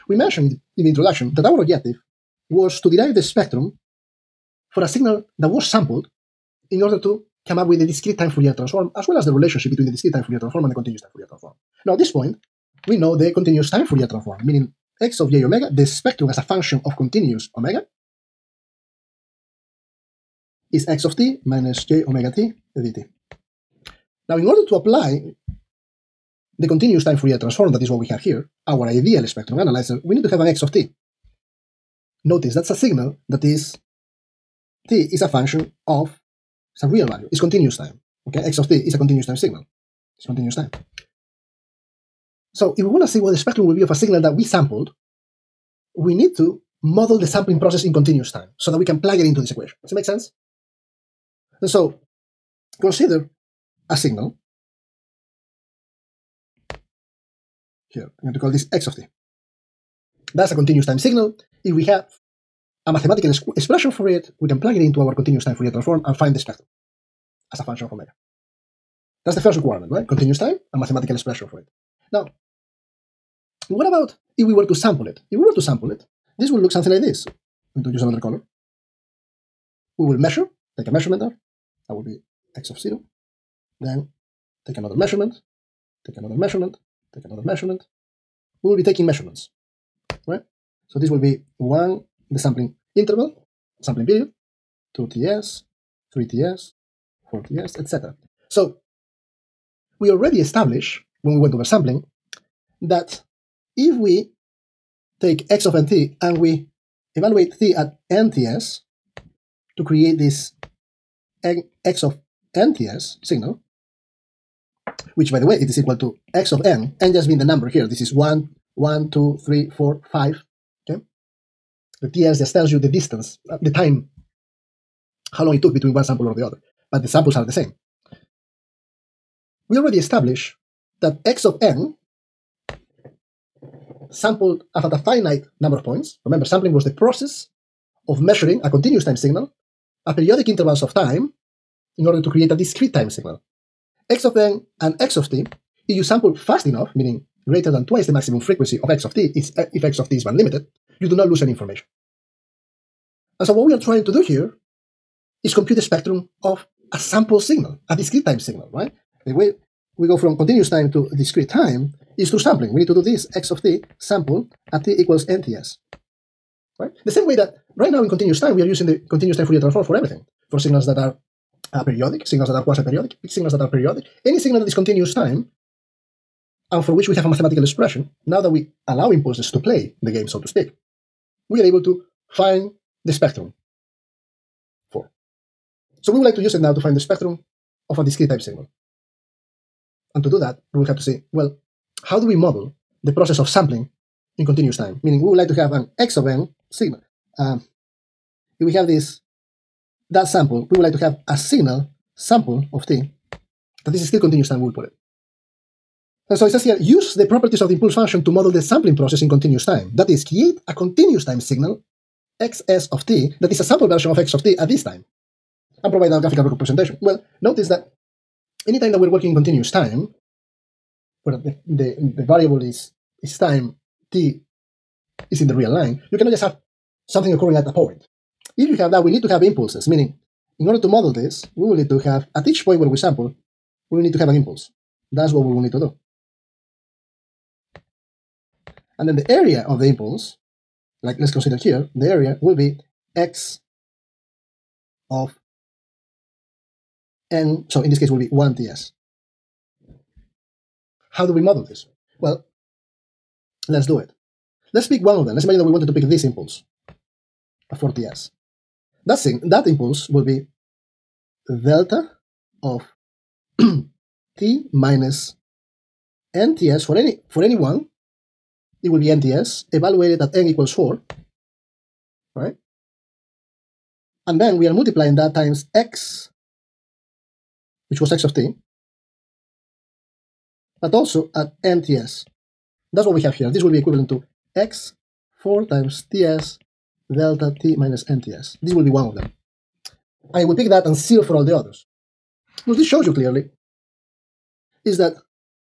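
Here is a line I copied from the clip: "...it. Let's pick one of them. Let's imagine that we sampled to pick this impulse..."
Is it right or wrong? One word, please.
wrong.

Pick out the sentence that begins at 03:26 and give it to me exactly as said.
And so it says here, use the properties of the impulse function to model the sampling process in continuous time.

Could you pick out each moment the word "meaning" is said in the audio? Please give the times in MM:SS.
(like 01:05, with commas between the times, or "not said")
00:14, 02:26, 03:15, 03:49.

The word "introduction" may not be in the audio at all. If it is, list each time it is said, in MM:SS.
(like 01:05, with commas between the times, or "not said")
00:00.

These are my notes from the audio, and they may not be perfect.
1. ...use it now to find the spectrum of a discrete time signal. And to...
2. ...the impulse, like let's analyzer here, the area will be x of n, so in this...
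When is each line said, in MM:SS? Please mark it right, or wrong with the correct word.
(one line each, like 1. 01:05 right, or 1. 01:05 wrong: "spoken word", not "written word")
1. 03:06 right
2. 03:59 wrong: "consider", not "analyzer".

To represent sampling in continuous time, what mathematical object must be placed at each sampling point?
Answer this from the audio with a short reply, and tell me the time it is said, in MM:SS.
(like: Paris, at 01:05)
an impulse, at 03:54.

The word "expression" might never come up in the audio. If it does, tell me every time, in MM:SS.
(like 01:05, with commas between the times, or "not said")
01:03, 01:11, 02:57.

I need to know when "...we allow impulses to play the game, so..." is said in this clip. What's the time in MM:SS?
02:58.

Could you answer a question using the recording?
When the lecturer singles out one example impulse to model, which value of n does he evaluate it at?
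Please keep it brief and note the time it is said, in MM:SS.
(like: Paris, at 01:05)
4, at 04:30.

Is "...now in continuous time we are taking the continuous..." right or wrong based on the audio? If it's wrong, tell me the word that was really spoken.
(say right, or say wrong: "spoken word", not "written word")
wrong: "using", not "taking".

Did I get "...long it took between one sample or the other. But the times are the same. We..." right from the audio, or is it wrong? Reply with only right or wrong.
wrong.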